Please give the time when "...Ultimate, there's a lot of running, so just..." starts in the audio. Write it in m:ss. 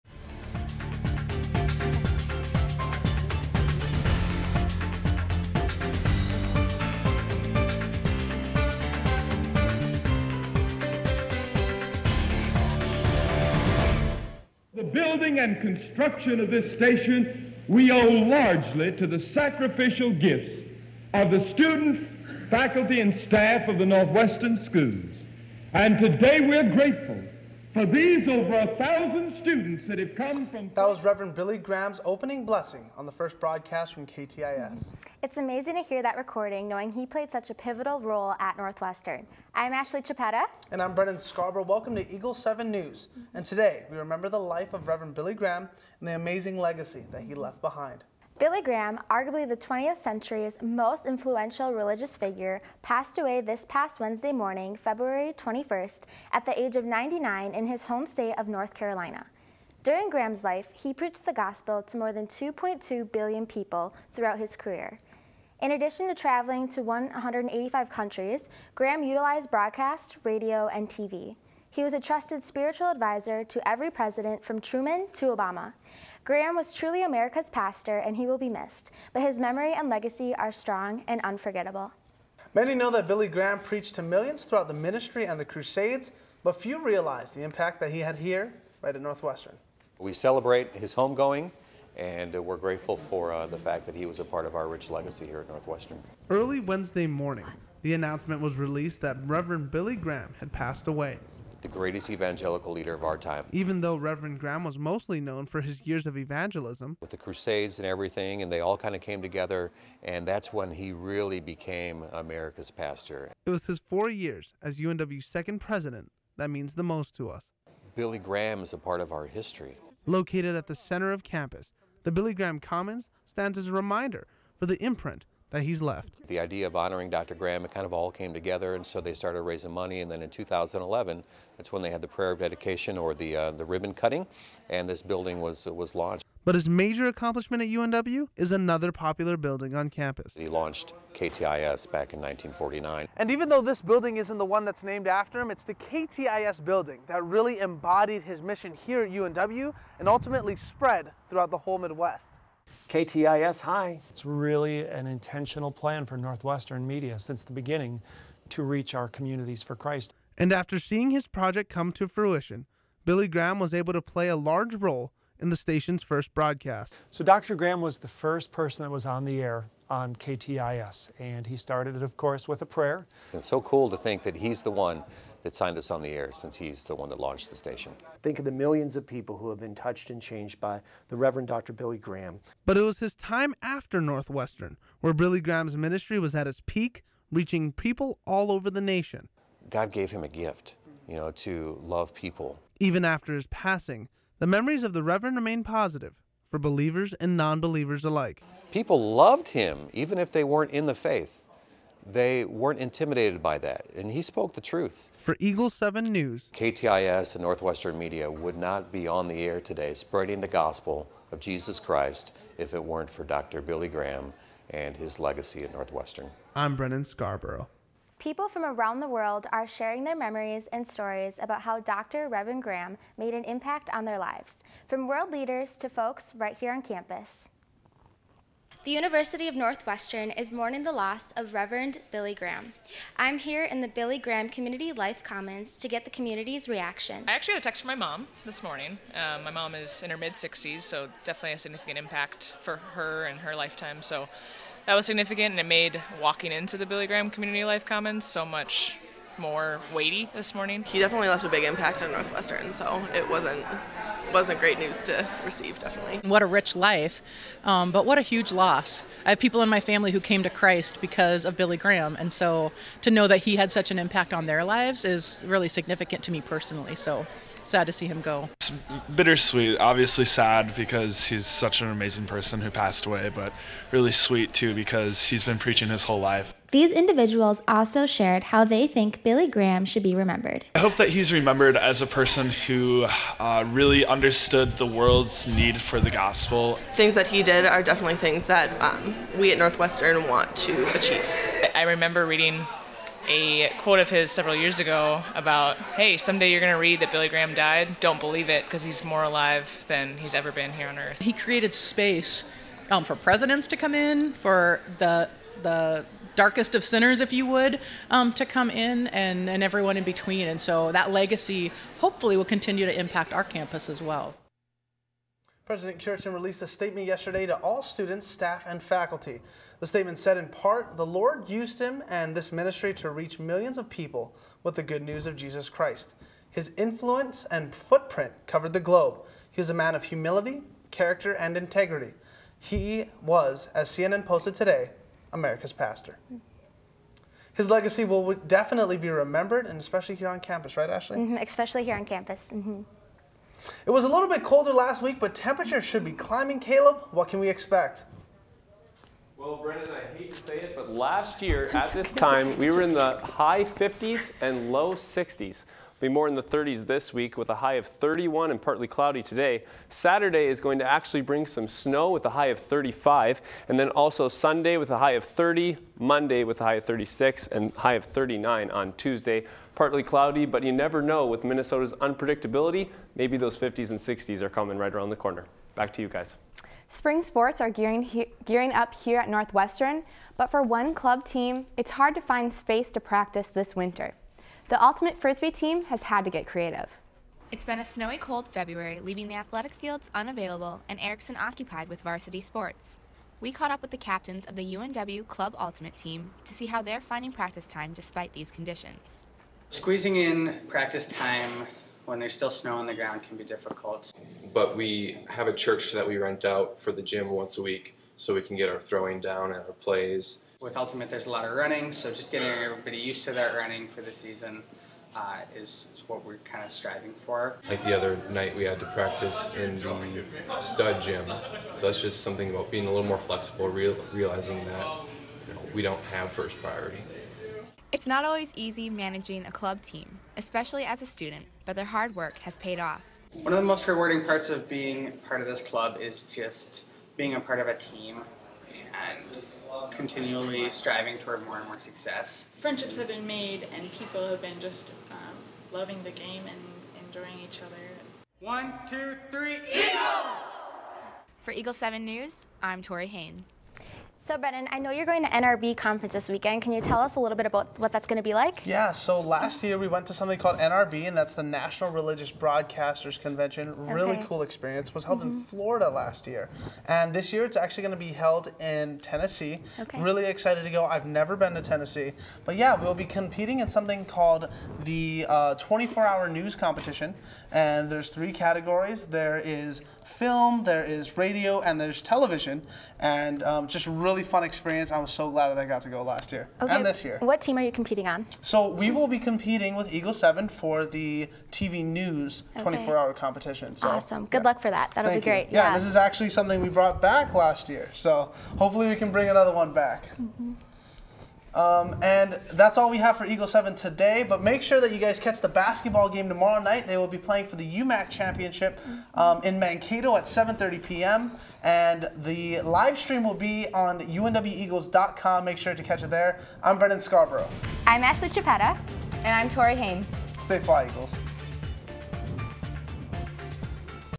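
6:50.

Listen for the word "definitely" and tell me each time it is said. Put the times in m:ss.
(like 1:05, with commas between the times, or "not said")
4:01, 4:10, 4:15, 4:47, 5:38.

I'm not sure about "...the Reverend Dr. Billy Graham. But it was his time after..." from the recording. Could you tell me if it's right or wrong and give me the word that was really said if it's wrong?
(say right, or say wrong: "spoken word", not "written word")
right.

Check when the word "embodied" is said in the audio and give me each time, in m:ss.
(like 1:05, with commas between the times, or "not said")
2:27.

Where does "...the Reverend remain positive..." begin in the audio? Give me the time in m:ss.
3:14.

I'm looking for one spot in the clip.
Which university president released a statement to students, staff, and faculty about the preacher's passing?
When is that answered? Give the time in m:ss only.
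5:15.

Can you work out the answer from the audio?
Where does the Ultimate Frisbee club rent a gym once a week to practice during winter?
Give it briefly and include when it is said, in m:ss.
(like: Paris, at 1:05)
A church, at 6:45.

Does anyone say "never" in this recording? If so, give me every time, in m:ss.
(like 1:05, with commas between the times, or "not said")
6:10, 7:51.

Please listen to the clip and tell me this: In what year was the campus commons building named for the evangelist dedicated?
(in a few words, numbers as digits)
2011.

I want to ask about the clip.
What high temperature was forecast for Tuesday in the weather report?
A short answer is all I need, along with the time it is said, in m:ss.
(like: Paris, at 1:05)
39, at 6:08.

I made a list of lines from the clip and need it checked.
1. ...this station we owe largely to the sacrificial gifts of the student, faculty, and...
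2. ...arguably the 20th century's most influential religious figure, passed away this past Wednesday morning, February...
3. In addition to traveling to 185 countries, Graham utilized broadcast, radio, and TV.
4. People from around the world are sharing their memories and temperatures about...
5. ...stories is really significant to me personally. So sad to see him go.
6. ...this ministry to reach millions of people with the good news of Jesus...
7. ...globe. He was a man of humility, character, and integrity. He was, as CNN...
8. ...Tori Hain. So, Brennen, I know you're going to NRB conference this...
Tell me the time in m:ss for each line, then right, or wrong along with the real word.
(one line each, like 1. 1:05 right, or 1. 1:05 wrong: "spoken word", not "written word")
1. 0:16 right
2. 0:49 right
3. 1:05 right
4. 3:38 wrong: "stories", not "temperatures"
5. 4:24 wrong: "lives", not "stories"
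6. 5:22 right
7. 5:28 right
8. 7:32 right.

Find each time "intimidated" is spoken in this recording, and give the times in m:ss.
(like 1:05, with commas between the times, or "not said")
3:22.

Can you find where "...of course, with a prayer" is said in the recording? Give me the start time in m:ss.
2:52.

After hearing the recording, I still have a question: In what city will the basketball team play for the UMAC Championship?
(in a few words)
Mankato.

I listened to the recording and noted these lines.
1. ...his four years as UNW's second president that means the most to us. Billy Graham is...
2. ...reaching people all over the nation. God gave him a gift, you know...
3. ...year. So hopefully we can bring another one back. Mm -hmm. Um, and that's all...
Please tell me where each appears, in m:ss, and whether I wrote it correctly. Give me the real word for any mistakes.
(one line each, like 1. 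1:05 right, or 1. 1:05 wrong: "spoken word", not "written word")
1. 1:53 right
2. 3:07 right
3. 8:17 right.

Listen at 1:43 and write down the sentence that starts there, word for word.
Even though Reverend Graham was mostly known for his years of evangelism.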